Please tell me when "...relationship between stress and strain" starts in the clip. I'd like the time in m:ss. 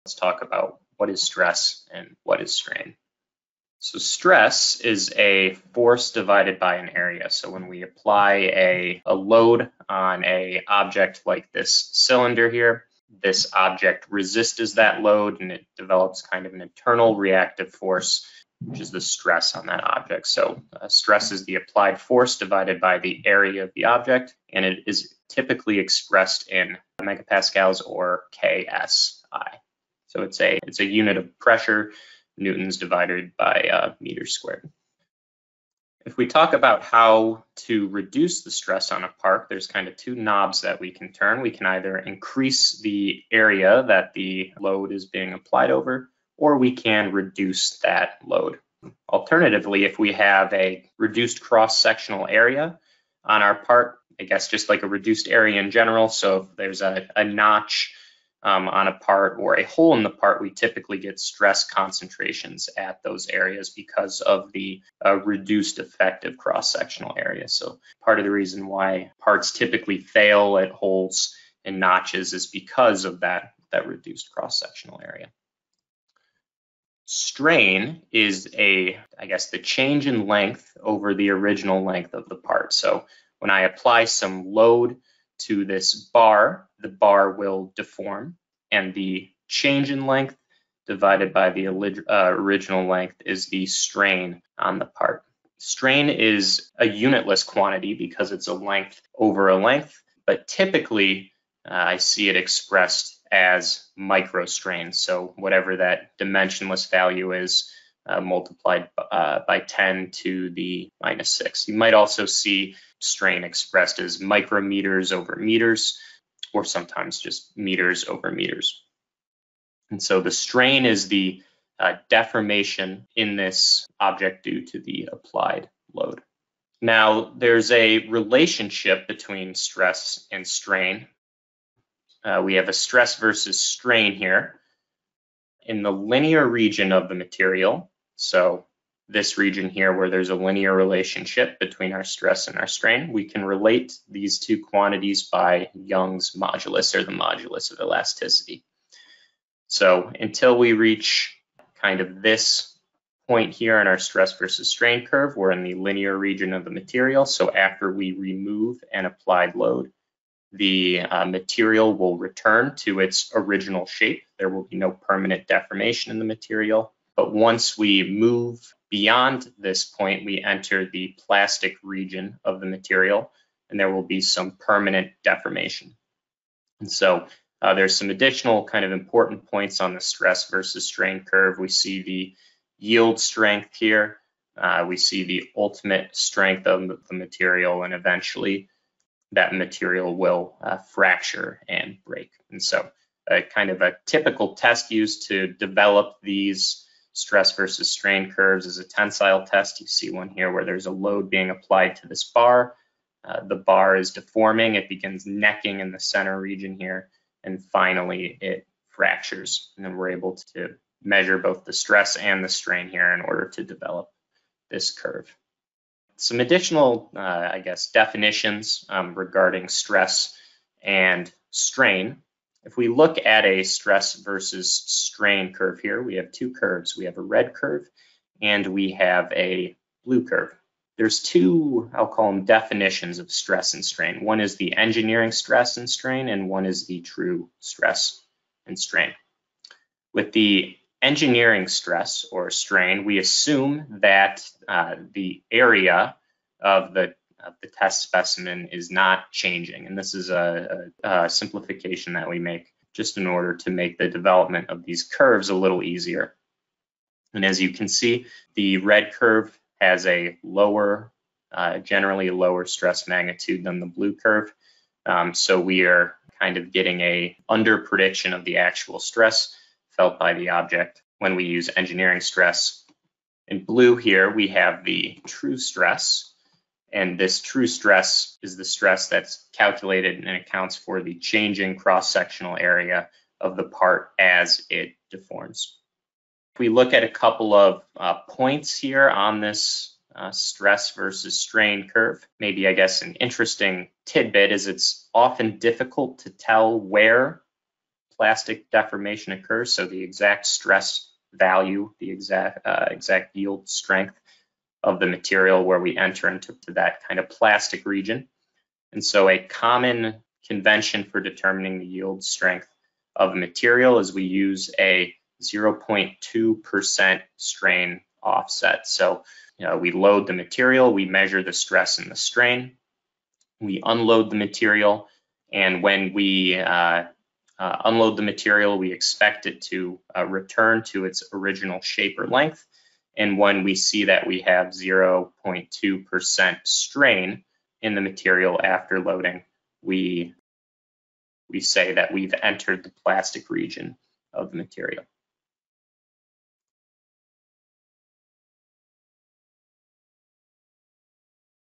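2:08.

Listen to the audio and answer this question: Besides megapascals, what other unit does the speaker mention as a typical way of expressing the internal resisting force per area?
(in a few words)
KSI.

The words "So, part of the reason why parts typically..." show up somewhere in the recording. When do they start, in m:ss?
1:07.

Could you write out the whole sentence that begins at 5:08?
And so a common convention for determining the yield strength of a material is we use a 0.2% strain offset.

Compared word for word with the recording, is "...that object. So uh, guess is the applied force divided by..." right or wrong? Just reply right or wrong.
wrong.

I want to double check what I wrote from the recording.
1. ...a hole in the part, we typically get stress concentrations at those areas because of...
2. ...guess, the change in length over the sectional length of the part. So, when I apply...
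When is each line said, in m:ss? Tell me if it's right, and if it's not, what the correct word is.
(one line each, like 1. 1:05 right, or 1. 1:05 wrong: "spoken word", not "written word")
1. 0:59 right
2. 1:19 wrong: "original", not "sectional".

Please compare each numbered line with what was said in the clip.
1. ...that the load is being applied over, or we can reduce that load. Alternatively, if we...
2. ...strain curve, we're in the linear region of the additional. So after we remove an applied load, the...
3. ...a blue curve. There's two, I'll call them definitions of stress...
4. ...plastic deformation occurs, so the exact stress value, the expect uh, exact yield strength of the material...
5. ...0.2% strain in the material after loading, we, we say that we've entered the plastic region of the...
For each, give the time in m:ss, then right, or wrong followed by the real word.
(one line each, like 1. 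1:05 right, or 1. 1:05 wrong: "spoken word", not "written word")
1. 0:43 right
2. 2:34 wrong: "material", not "additional"
3. 3:49 right
4. 4:58 wrong: "exact", not "expect"
5. 5:34 right.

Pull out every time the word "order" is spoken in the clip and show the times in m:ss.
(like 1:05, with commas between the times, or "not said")
3:33, 4:13.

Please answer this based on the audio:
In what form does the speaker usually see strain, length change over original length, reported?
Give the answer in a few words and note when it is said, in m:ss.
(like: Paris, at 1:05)
microstrain, at 1:43.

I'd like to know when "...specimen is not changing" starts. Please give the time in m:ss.
4:08.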